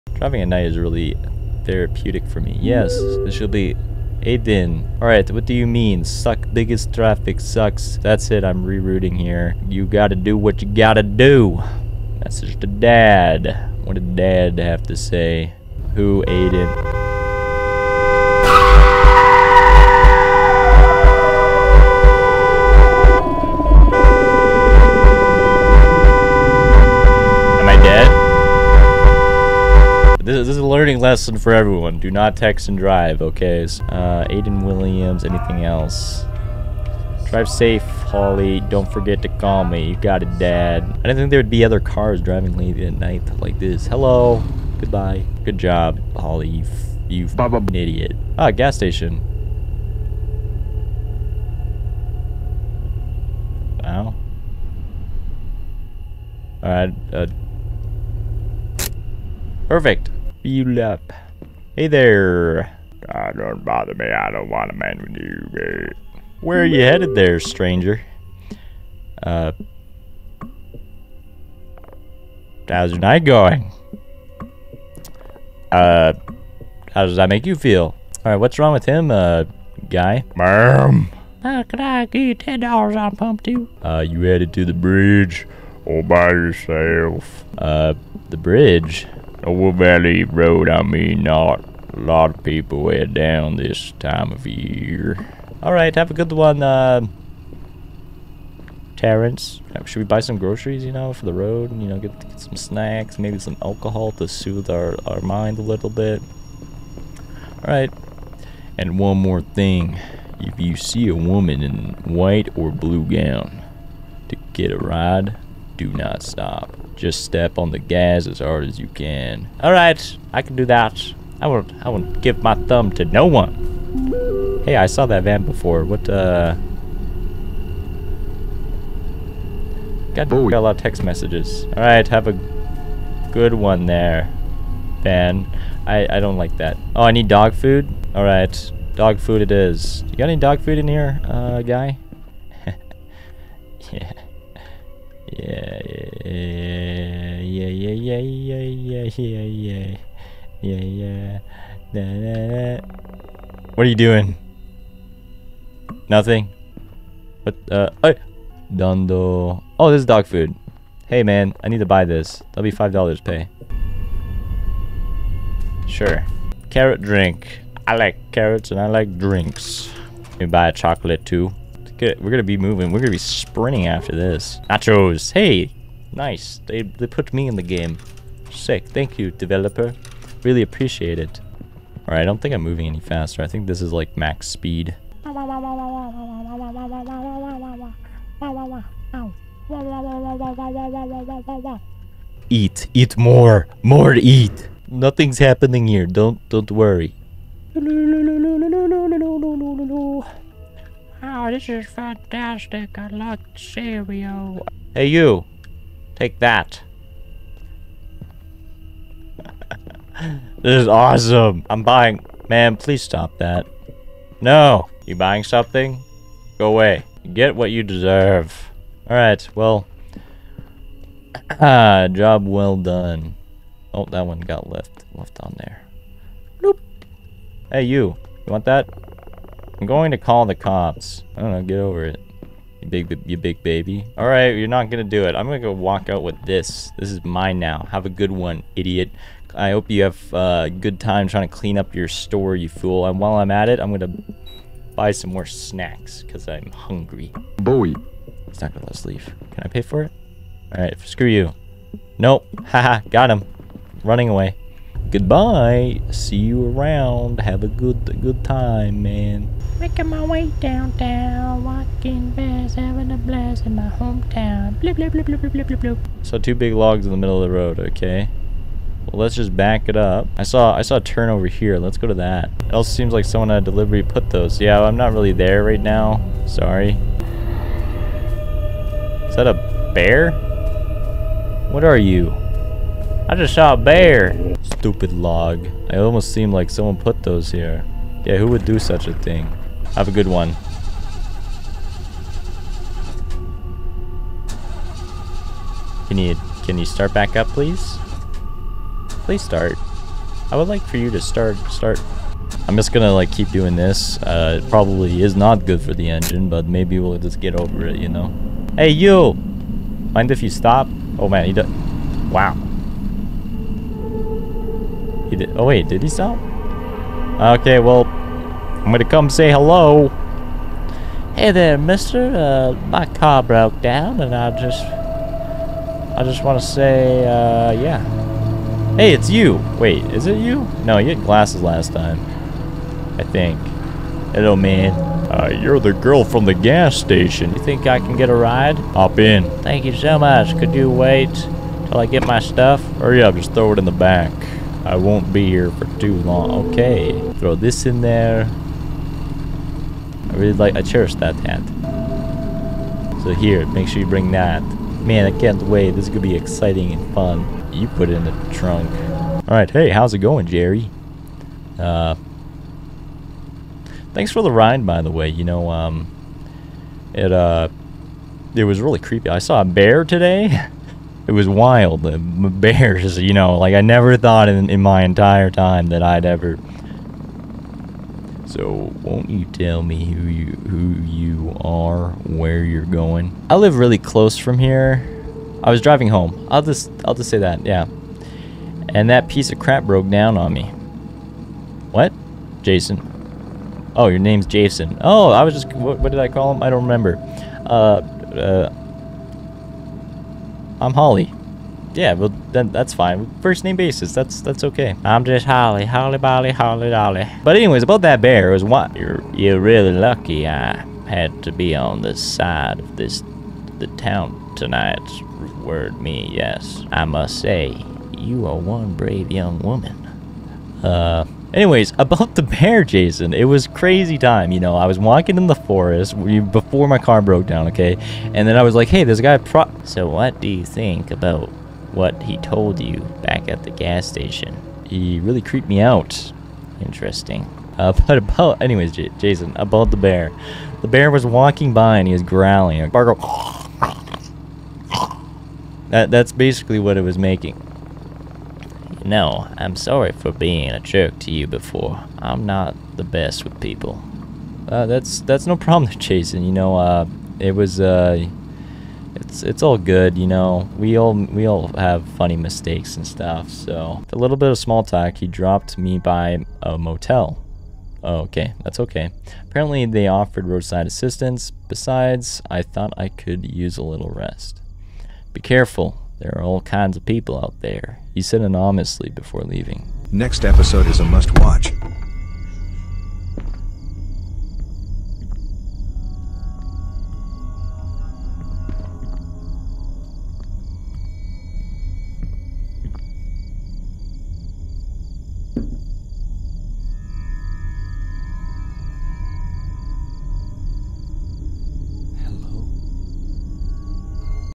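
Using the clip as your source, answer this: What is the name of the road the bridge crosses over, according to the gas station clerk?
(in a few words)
Valley Road.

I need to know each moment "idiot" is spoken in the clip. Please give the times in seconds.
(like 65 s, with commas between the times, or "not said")
47 s, 238 s.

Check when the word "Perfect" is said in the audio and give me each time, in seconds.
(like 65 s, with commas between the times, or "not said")
59 s.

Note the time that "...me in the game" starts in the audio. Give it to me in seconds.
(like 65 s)
177 s.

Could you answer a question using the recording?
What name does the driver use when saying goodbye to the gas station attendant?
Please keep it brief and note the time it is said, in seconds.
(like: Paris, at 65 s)
Terrence, at 98 s.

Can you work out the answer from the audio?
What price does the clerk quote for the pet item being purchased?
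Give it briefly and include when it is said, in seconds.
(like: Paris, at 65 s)
$5, at 162 s.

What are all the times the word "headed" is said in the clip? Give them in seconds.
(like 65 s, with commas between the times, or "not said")
66 s, 84 s.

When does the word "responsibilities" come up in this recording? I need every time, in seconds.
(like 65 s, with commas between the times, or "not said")
not said.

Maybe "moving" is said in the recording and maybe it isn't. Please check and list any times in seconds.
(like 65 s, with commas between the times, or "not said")
172 s, 182 s.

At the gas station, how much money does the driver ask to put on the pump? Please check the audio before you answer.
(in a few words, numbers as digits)
$10.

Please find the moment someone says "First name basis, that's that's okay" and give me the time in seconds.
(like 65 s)
403 s.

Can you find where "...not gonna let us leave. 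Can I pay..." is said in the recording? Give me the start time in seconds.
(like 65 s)
248 s.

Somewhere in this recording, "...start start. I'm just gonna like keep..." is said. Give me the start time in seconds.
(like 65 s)
301 s.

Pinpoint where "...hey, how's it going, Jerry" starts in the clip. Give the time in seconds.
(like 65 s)
359 s.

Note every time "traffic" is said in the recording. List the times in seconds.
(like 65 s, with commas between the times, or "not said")
6 s.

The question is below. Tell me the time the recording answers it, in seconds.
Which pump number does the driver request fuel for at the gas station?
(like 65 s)
83 s.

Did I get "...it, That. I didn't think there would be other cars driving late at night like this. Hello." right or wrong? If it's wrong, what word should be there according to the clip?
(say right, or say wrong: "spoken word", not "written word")
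wrong: "Dad", not "That".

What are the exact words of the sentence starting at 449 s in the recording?
You know, I'm sorry for being a jerk to you before.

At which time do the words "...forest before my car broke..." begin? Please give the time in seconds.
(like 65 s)
425 s.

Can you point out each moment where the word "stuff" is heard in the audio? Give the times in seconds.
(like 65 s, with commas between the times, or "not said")
342 s, 463 s.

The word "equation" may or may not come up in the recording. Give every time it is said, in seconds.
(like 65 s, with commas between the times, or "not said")
not said.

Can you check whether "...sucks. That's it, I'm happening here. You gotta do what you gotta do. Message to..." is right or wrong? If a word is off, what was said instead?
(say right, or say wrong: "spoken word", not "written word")
wrong: "rerouting", not "happening".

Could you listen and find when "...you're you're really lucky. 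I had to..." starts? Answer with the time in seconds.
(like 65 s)
408 s.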